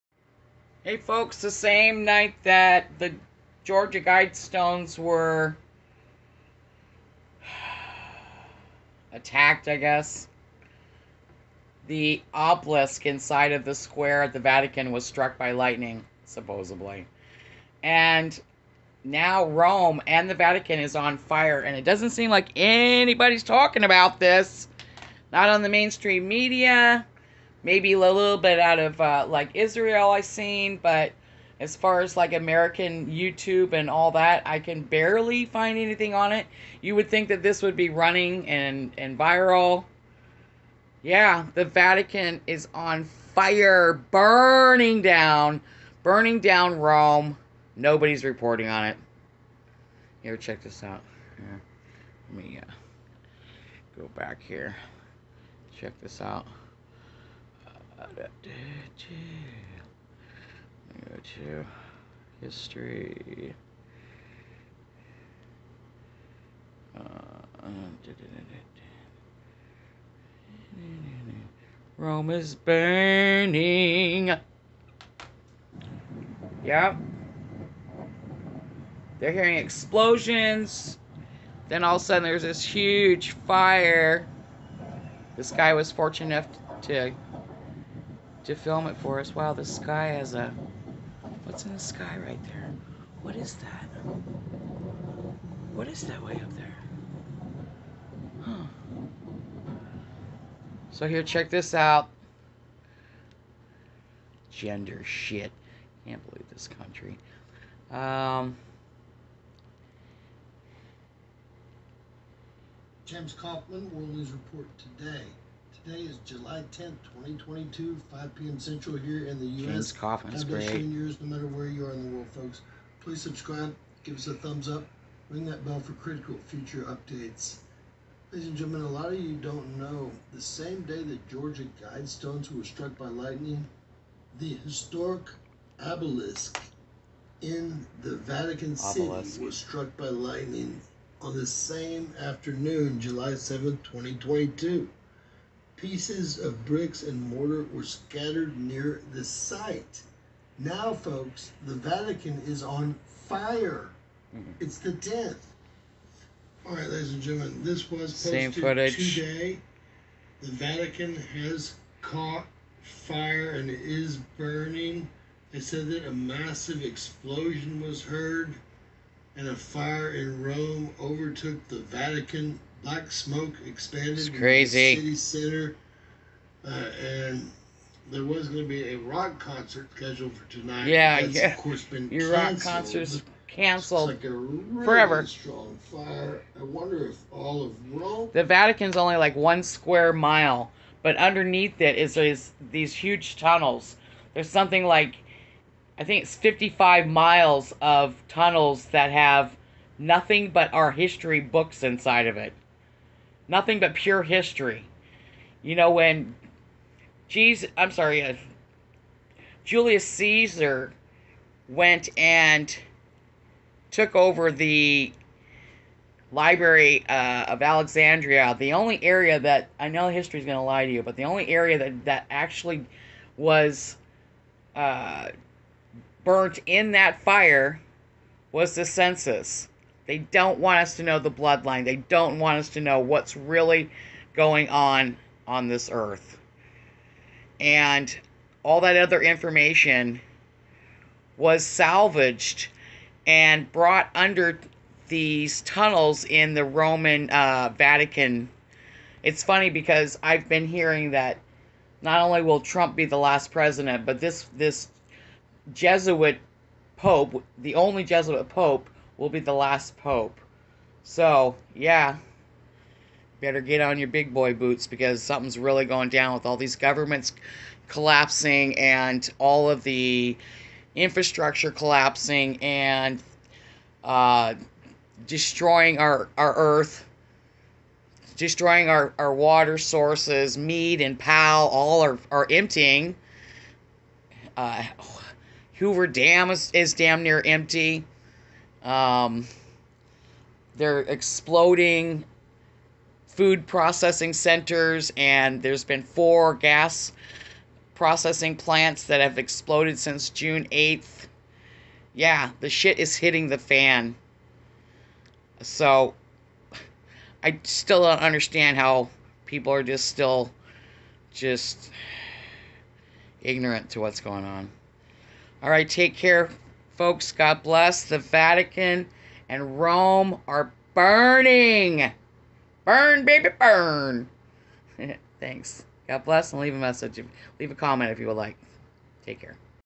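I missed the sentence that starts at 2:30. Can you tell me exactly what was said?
Now, folks, the Vatican is on fire.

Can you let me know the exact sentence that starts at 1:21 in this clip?
Then all of a sudden there's this huge fire.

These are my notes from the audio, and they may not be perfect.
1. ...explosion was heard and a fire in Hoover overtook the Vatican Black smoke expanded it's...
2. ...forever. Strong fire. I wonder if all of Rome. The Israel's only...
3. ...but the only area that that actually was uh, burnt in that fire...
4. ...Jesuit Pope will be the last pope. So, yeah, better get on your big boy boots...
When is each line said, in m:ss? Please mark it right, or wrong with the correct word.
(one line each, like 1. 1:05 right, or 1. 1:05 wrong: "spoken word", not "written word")
1. 2:46 wrong: "Rome", not "Hoover"
2. 3:04 wrong: "Vatican", not "Israel"
3. 3:41 right
4. 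4:18 right.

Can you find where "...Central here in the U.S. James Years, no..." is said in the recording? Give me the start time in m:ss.
1:58.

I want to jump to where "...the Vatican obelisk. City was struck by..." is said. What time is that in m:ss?
2:18.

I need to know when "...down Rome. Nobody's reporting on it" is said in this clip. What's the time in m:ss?
0:46.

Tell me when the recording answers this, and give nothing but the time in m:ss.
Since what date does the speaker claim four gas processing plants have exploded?
5:00.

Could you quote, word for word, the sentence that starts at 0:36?
You would think that this would be running and and viral.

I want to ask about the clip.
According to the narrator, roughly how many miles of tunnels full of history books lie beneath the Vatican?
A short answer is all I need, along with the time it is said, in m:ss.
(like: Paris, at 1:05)
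55, at 3:16.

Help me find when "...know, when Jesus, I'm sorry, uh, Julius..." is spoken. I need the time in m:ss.
3:25.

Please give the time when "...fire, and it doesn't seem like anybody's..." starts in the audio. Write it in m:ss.
0:21.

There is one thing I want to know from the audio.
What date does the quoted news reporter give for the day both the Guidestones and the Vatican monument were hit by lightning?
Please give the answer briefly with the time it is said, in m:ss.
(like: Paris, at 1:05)
July 7th, 2022, at 2:22.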